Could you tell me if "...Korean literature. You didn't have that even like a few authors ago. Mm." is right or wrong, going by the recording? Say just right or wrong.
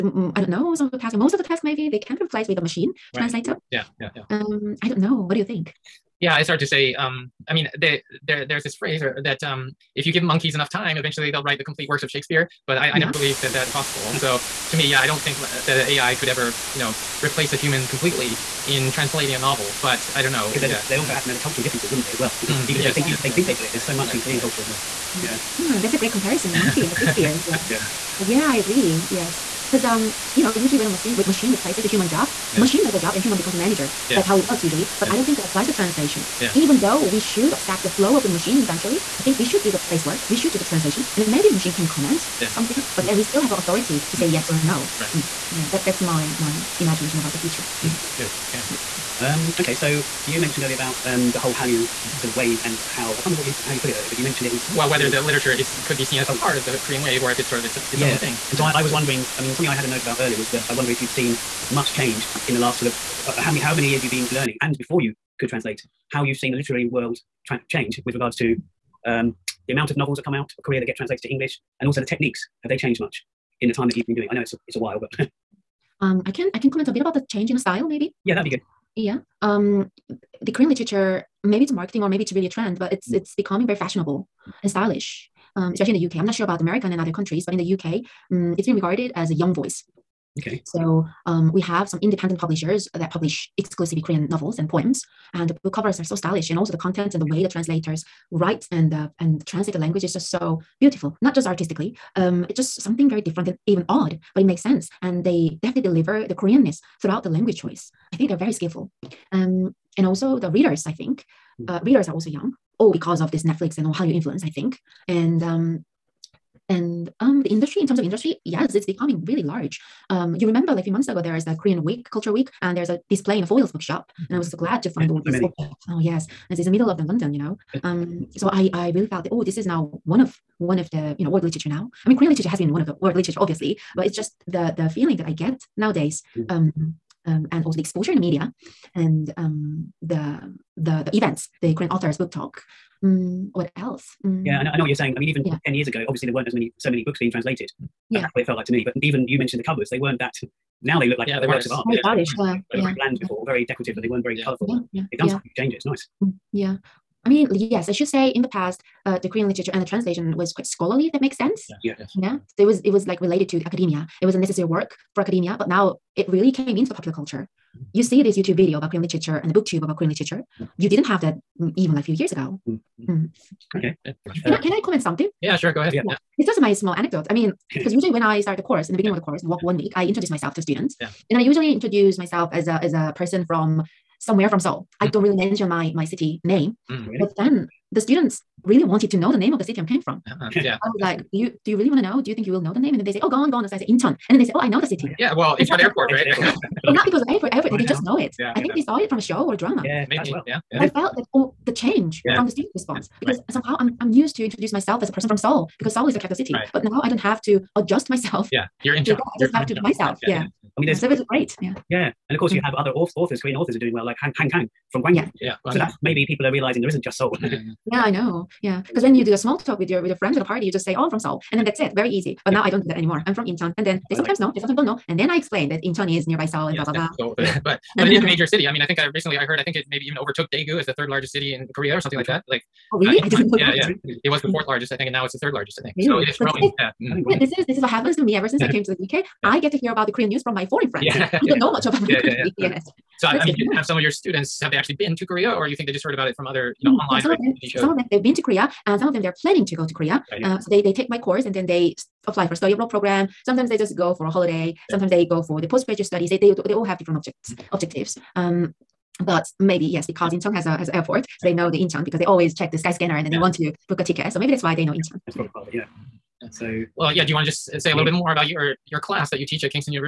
wrong.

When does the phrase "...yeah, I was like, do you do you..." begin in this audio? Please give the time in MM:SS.
03:10.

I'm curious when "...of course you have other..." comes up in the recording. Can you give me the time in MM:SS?
03:32.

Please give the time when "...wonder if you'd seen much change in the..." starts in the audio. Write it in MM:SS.
01:00.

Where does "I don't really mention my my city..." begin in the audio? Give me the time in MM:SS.
03:05.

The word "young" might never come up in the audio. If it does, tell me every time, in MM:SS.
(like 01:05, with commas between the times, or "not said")
01:29, 01:52.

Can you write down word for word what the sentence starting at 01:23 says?
it's becoming very fashionable and stylish, um, especially in the UK.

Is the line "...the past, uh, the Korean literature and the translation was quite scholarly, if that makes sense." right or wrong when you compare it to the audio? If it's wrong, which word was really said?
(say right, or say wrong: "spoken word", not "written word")
right.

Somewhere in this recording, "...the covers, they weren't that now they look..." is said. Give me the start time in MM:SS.
02:29.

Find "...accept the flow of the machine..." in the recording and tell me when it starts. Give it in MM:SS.
00:37.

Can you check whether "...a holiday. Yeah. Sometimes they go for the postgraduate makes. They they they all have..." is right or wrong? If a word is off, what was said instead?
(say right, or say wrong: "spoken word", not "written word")
wrong: "studies", not "makes".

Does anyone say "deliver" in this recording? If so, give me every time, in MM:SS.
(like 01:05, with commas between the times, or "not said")
01:45.